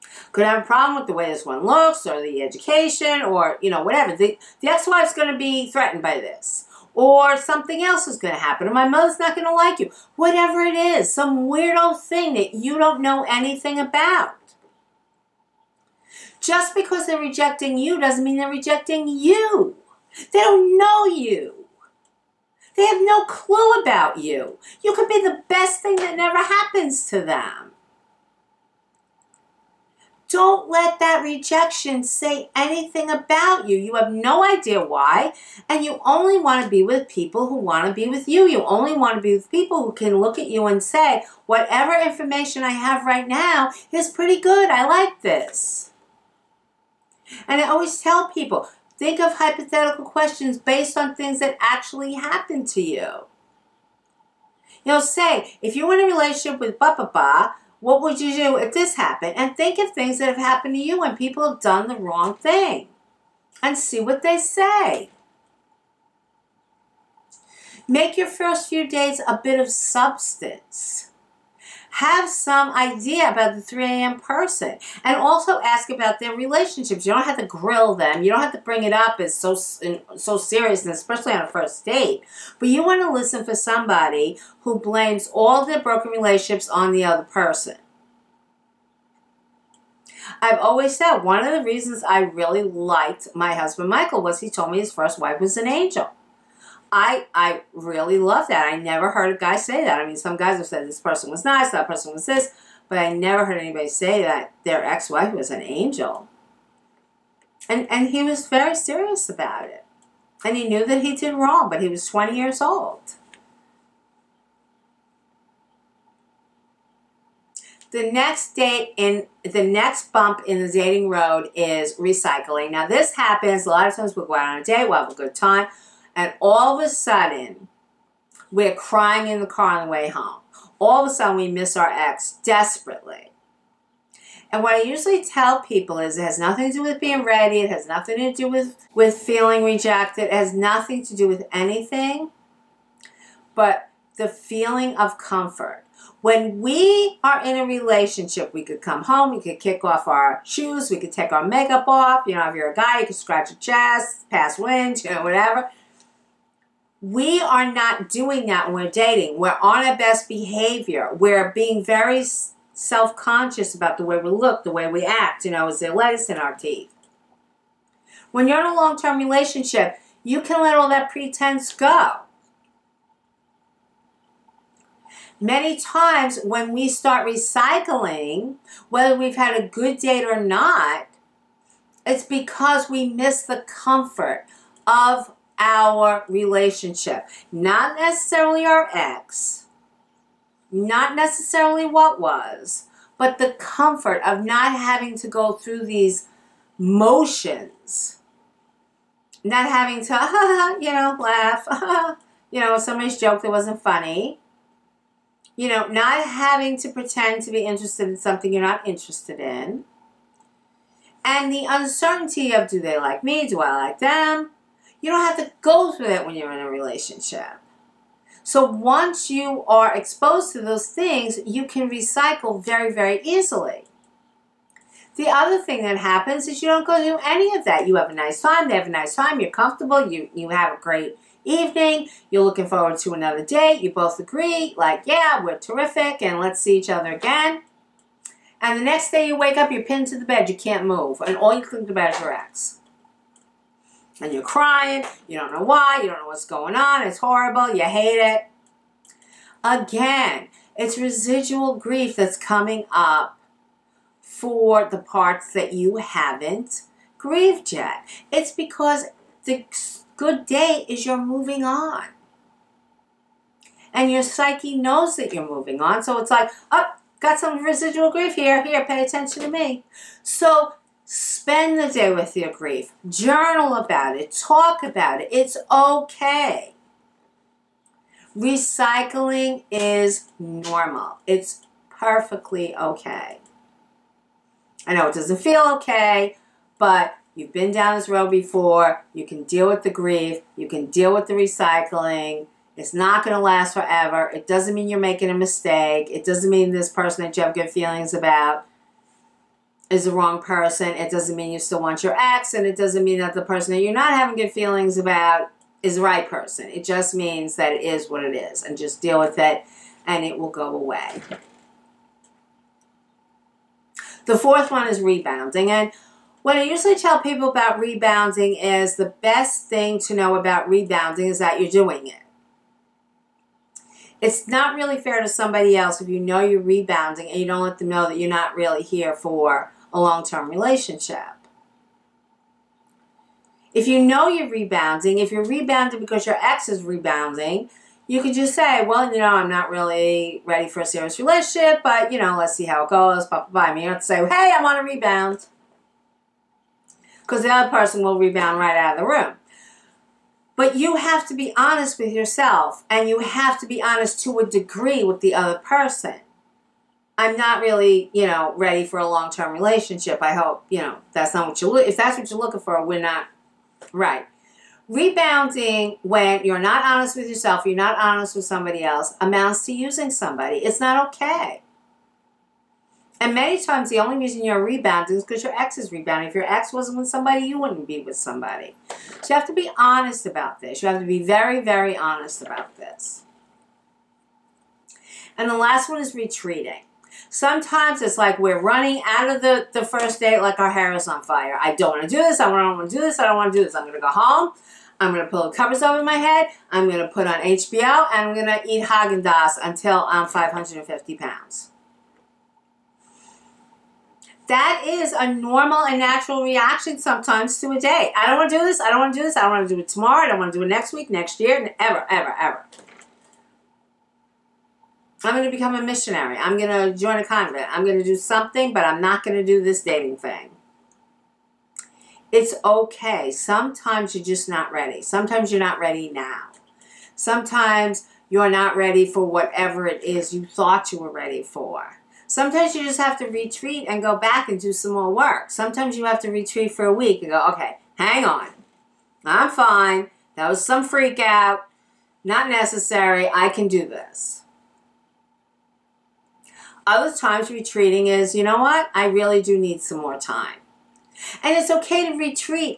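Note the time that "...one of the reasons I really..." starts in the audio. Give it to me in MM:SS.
01:31.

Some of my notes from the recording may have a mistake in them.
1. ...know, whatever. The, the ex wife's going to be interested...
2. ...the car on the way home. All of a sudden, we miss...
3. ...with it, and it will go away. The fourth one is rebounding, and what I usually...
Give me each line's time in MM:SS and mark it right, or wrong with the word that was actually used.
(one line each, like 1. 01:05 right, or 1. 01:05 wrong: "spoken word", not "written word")
1. 00:03 wrong: "threatened", not "interested"
2. 02:09 right
3. 05:09 right.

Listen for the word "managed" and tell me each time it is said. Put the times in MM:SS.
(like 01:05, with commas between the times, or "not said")
not said.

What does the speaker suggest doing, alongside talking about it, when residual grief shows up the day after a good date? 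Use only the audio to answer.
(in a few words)
Journal about it.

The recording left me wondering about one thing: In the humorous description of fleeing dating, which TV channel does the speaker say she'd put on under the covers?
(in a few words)
HBO.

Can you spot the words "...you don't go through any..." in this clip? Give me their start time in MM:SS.
03:46.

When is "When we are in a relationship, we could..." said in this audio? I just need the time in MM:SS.
02:26.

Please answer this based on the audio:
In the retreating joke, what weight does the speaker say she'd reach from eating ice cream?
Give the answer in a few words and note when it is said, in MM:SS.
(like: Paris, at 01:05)
550 pounds, at 06:40.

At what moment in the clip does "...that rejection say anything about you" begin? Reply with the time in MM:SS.
00:30.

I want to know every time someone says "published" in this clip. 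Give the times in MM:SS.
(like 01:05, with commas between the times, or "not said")
not said.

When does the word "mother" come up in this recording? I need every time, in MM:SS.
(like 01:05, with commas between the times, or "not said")
00:08.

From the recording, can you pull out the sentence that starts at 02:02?
Now this happens a lot of times.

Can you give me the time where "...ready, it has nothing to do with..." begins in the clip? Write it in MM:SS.
02:17.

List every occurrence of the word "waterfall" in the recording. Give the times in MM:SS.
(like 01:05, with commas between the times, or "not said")
not said.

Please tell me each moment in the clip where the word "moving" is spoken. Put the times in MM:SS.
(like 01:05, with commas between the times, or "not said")
04:21, 04:25.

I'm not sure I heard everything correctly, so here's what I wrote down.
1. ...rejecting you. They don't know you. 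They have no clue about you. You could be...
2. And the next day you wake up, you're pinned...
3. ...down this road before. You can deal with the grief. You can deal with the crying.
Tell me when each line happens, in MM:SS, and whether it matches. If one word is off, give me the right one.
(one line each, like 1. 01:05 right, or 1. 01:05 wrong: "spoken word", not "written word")
1. 00:18 right
2. 03:58 right
3. 04:47 wrong: "recycling", not "crying".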